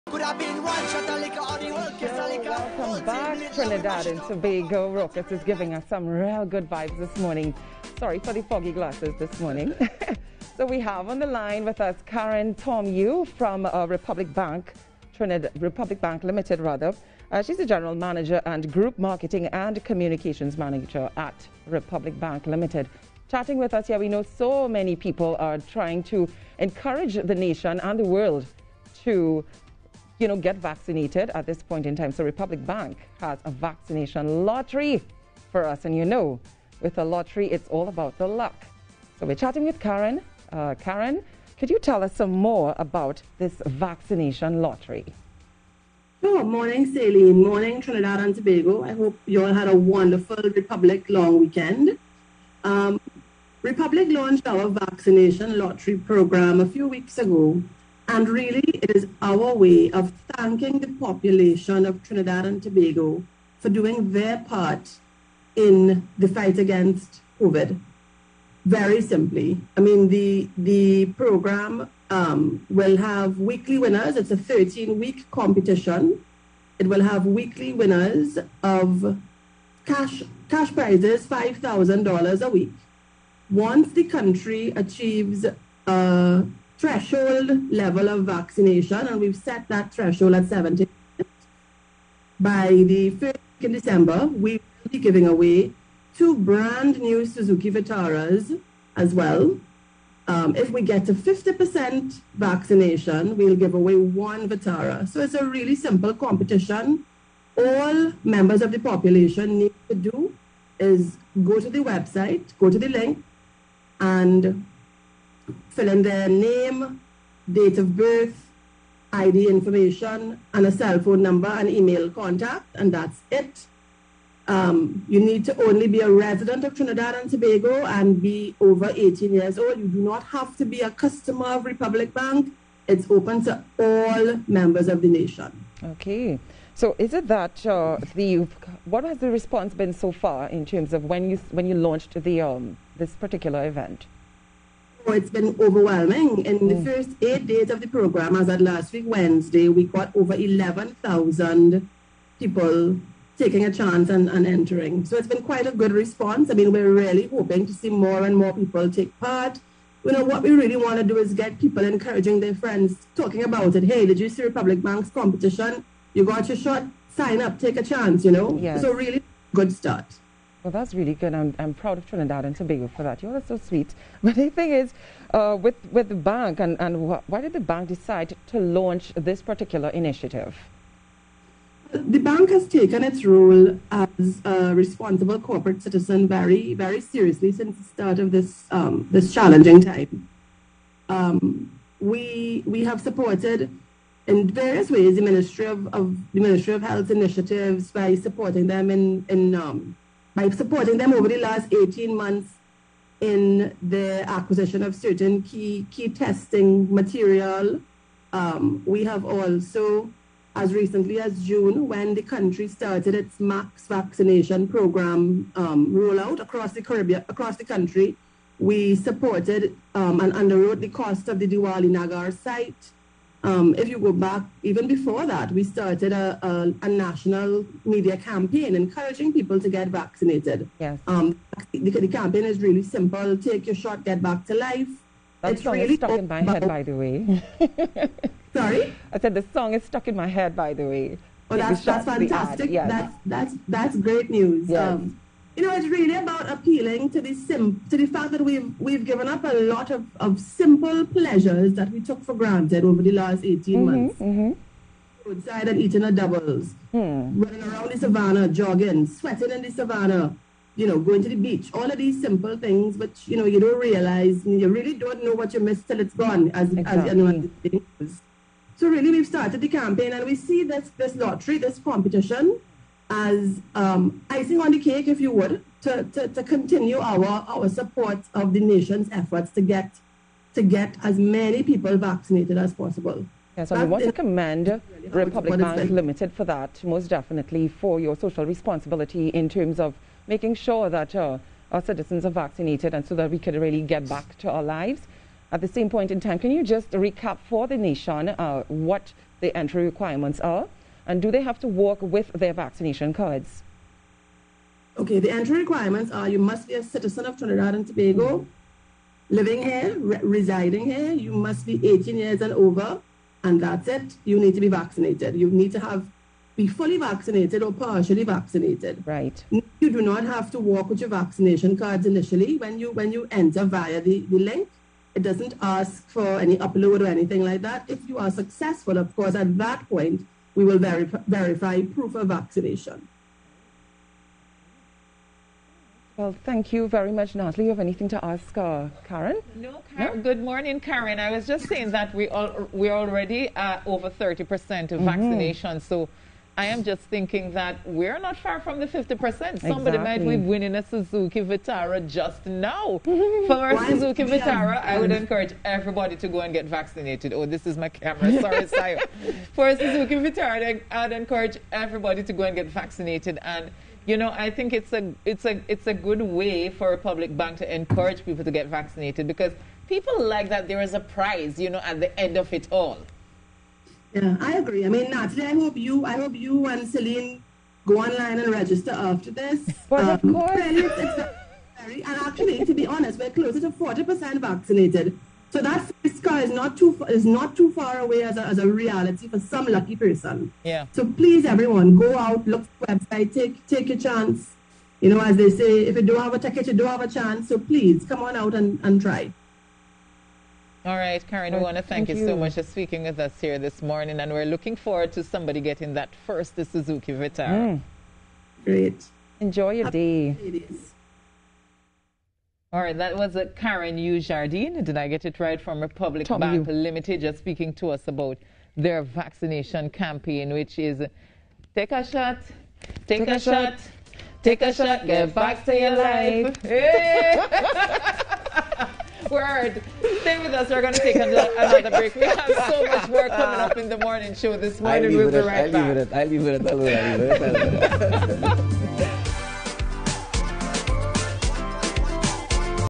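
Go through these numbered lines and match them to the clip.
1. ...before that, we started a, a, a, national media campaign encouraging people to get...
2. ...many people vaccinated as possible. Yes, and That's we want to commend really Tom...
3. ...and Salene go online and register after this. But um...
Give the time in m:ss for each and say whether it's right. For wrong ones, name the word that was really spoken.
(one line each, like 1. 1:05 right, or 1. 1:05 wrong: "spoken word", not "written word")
1. 3:44 right
2. 4:41 wrong: "Republic", not "Tom"
3. 6:16 right.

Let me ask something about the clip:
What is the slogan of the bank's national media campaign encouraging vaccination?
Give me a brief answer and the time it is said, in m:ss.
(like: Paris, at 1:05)
Take your shot, get back to life, at 3:53.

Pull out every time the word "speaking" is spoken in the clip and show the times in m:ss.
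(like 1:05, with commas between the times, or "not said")
6:42, 6:57.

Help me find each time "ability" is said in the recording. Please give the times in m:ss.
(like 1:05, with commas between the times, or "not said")
not said.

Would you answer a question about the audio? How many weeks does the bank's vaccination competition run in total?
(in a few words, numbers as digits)
13.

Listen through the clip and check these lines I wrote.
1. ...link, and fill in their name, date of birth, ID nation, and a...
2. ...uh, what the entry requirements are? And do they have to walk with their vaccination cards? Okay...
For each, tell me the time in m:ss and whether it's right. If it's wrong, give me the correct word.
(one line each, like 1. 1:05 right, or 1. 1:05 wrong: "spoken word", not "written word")
1. 1:52 wrong: "information", not "nation"
2. 4:58 right.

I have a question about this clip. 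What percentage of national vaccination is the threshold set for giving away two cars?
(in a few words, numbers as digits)
70%.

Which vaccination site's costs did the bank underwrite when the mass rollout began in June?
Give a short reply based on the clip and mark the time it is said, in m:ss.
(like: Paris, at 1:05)
Diwali Nagar, at 3:41.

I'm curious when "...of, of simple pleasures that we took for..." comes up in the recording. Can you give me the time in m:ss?
4:09.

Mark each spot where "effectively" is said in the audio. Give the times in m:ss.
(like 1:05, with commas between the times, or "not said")
not said.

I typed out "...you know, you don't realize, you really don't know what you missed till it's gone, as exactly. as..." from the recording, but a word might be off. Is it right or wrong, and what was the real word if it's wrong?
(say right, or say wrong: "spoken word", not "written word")
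right.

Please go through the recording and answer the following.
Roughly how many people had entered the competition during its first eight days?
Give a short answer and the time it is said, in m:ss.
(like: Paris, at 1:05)
over 11,000, at 2:30.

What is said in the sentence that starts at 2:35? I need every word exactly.
So it's been quite a good response.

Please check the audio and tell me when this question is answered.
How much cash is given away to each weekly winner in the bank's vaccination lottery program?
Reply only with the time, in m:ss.
1:21.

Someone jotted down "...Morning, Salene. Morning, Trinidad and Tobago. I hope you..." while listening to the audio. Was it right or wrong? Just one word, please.
right.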